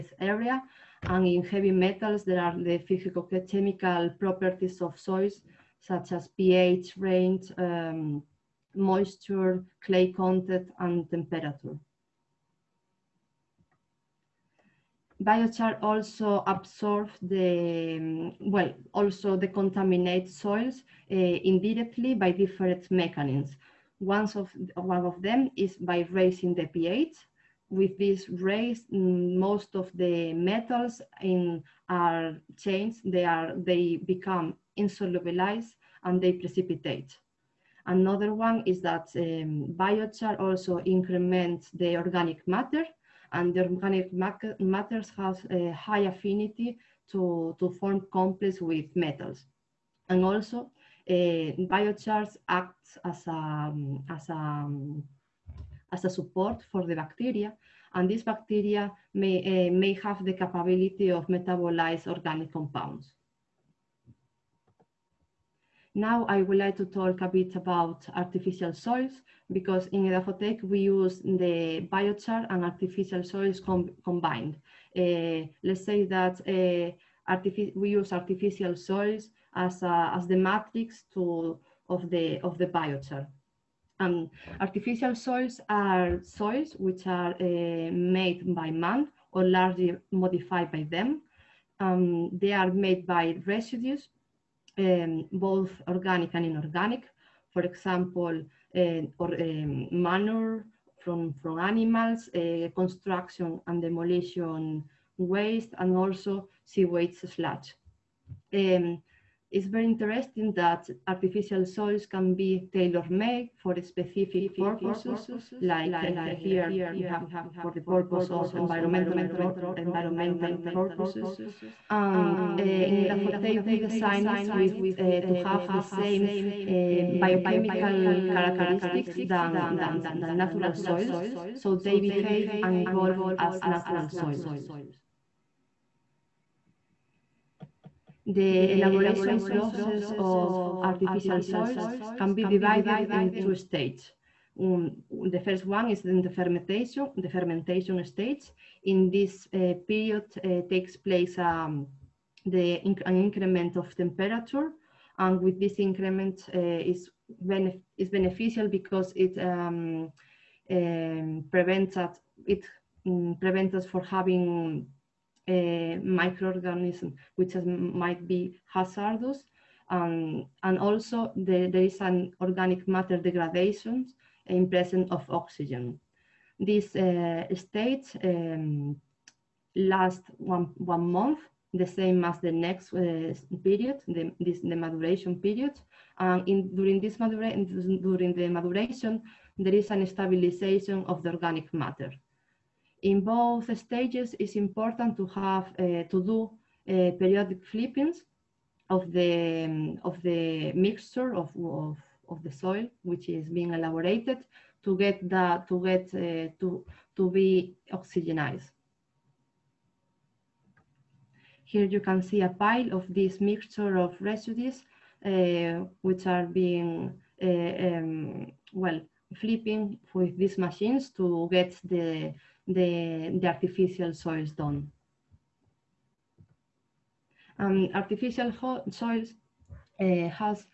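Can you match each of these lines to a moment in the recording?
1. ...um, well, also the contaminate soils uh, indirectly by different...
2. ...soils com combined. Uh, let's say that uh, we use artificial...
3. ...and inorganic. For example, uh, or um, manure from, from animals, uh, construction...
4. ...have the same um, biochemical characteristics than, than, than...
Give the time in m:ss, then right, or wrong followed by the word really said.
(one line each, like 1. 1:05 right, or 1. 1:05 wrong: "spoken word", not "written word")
1. 0:18 right
2. 1:13 right
3. 1:36 right
4. 2:05 right.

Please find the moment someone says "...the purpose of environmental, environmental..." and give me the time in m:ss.
1:57.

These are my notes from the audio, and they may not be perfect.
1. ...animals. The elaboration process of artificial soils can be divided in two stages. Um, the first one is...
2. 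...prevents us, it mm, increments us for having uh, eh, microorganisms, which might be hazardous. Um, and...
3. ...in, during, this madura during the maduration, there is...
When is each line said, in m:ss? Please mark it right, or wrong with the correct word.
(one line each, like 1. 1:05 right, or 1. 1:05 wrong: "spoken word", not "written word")
1. 2:14 wrong: "soils", not "animals"
2. 2:41 wrong: "prevents", not "increments"
3. 3:06 right.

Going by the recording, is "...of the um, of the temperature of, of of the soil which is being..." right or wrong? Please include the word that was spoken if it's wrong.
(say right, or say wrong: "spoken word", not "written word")
wrong: "mixture", not "temperature".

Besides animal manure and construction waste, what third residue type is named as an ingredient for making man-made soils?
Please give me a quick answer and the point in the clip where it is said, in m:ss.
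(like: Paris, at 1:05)
Sewage sludge, at 1:46.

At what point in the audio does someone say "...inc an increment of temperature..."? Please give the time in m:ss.
2:32.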